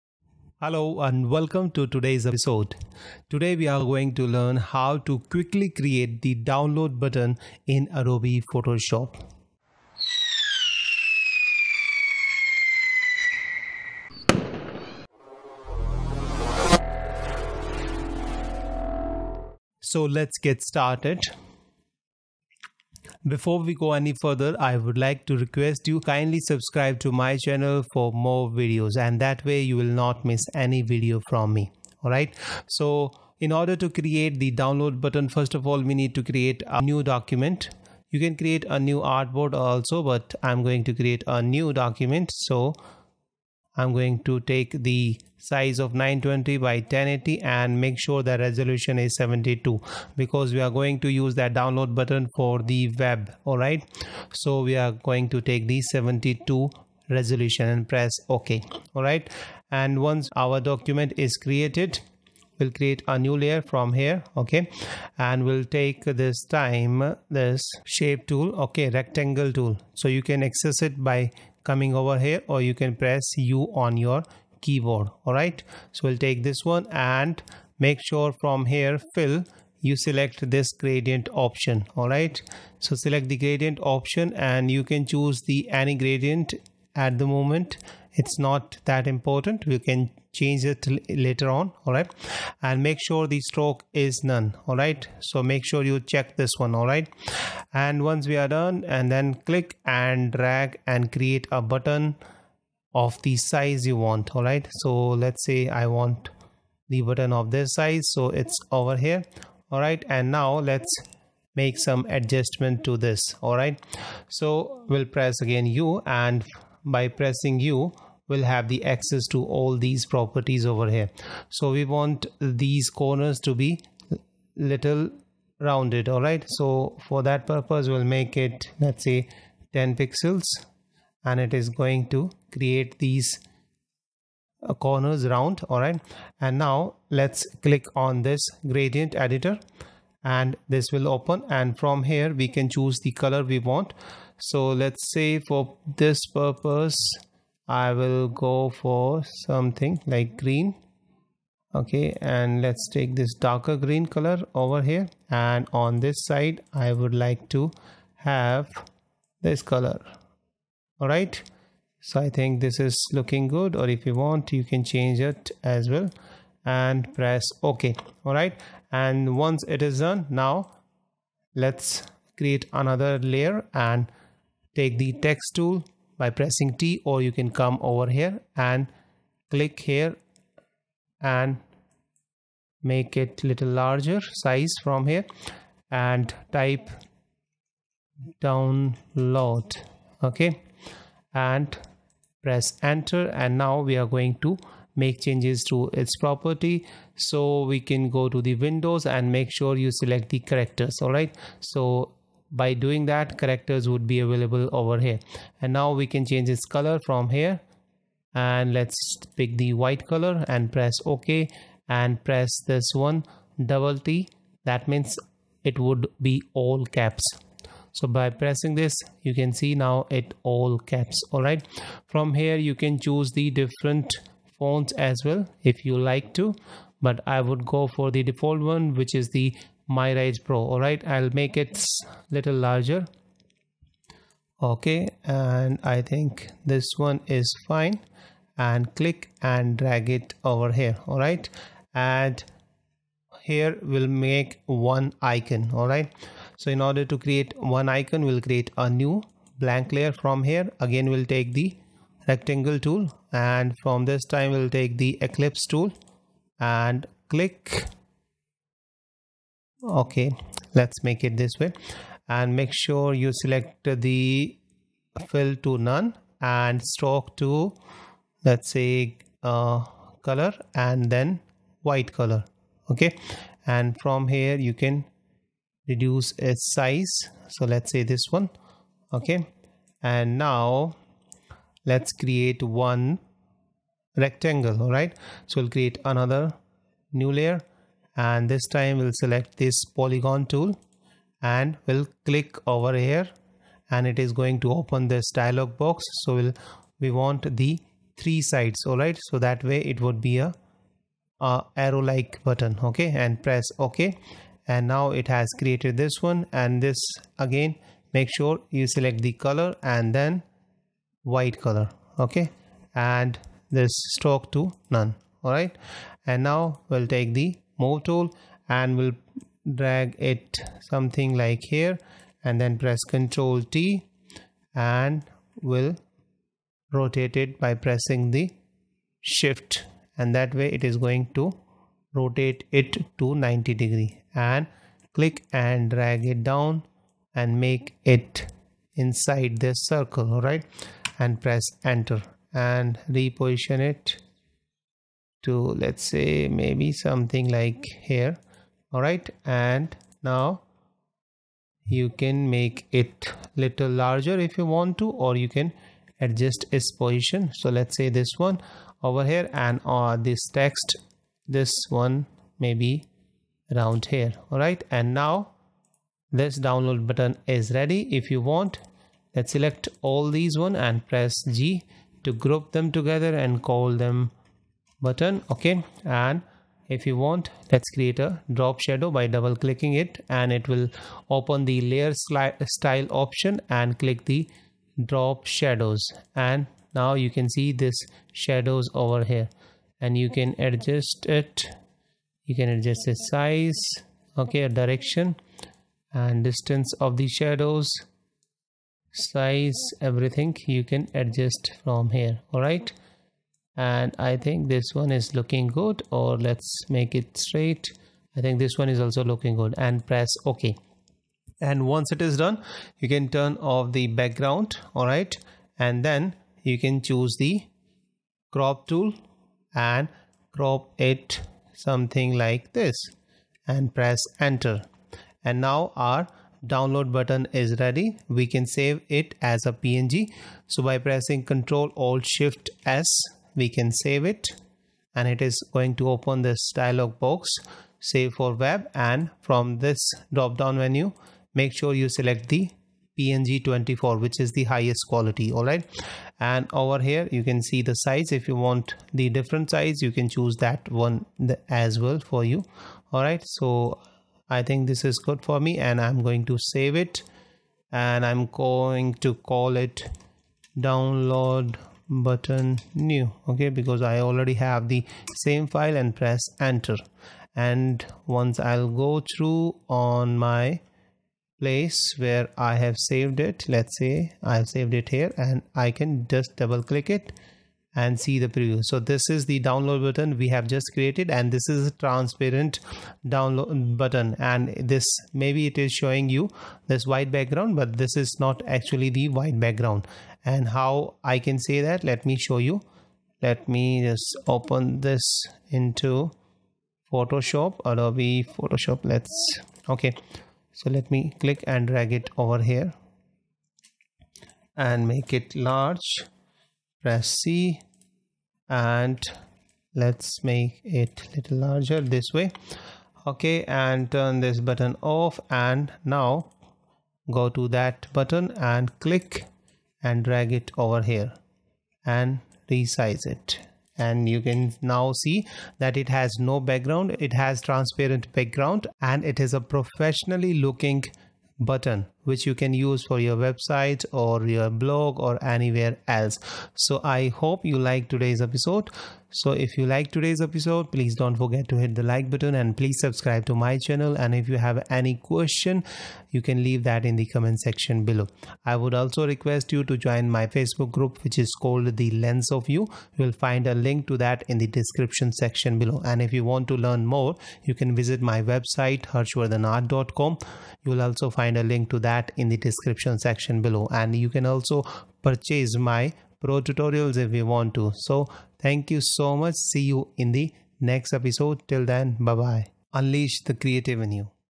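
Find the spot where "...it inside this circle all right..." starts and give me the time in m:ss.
5:38.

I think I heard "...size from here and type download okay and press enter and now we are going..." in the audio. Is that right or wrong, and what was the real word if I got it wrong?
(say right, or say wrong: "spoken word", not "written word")
right.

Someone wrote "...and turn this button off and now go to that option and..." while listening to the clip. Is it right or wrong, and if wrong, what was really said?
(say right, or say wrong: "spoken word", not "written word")
wrong: "button", not "option".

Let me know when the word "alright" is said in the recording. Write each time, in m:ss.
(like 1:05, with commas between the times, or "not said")
0:32, 3:50, 4:01, 4:05.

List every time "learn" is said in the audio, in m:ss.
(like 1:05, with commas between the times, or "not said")
0:04, 9:16.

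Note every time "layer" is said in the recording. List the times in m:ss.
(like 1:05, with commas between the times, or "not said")
1:03, 2:53, 4:09, 4:47, 6:21.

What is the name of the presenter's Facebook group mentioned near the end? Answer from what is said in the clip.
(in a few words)
The Lens of You.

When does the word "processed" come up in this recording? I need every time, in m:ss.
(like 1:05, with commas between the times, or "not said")
not said.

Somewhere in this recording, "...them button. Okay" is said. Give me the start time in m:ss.
6:13.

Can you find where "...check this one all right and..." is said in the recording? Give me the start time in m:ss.
1:35.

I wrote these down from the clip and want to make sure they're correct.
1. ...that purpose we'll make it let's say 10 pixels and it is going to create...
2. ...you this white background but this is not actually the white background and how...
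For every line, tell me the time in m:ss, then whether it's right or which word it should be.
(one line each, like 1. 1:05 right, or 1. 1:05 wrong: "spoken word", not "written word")
1. 2:07 right
2. 8:06 right.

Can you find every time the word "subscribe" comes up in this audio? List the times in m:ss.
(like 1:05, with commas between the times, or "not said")
0:26, 9:02.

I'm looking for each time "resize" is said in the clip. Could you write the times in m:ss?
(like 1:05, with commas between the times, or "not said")
8:42.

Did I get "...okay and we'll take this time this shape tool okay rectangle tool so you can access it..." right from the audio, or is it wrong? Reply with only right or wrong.
right.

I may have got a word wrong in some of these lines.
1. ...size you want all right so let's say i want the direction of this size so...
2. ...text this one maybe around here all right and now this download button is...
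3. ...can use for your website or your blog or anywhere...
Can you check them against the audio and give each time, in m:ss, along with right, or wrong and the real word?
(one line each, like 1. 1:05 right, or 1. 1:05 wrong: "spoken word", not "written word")
1. 1:43 wrong: "button", not "direction"
2. 6:00 right
3. 8:52 right.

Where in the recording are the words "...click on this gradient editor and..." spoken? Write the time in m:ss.
2:17.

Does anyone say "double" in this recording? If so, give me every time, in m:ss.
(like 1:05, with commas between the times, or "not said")
3:33, 6:19, 7:56.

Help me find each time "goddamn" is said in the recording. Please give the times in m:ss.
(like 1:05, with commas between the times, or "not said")
not said.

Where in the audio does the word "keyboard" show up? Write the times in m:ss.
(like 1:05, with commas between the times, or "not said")
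1:14.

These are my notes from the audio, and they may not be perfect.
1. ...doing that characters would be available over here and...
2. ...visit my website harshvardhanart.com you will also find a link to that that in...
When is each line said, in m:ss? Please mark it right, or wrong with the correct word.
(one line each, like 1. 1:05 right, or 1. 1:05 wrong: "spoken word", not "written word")
1. 3:22 right
2. 9:17 right.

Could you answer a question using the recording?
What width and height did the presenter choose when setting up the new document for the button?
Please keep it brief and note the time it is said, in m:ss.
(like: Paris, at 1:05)
920 by 1080, at 0:45.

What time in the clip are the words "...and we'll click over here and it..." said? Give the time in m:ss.
4:51.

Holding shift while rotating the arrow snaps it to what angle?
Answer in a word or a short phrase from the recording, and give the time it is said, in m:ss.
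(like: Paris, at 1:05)
90 degrees, at 5:33.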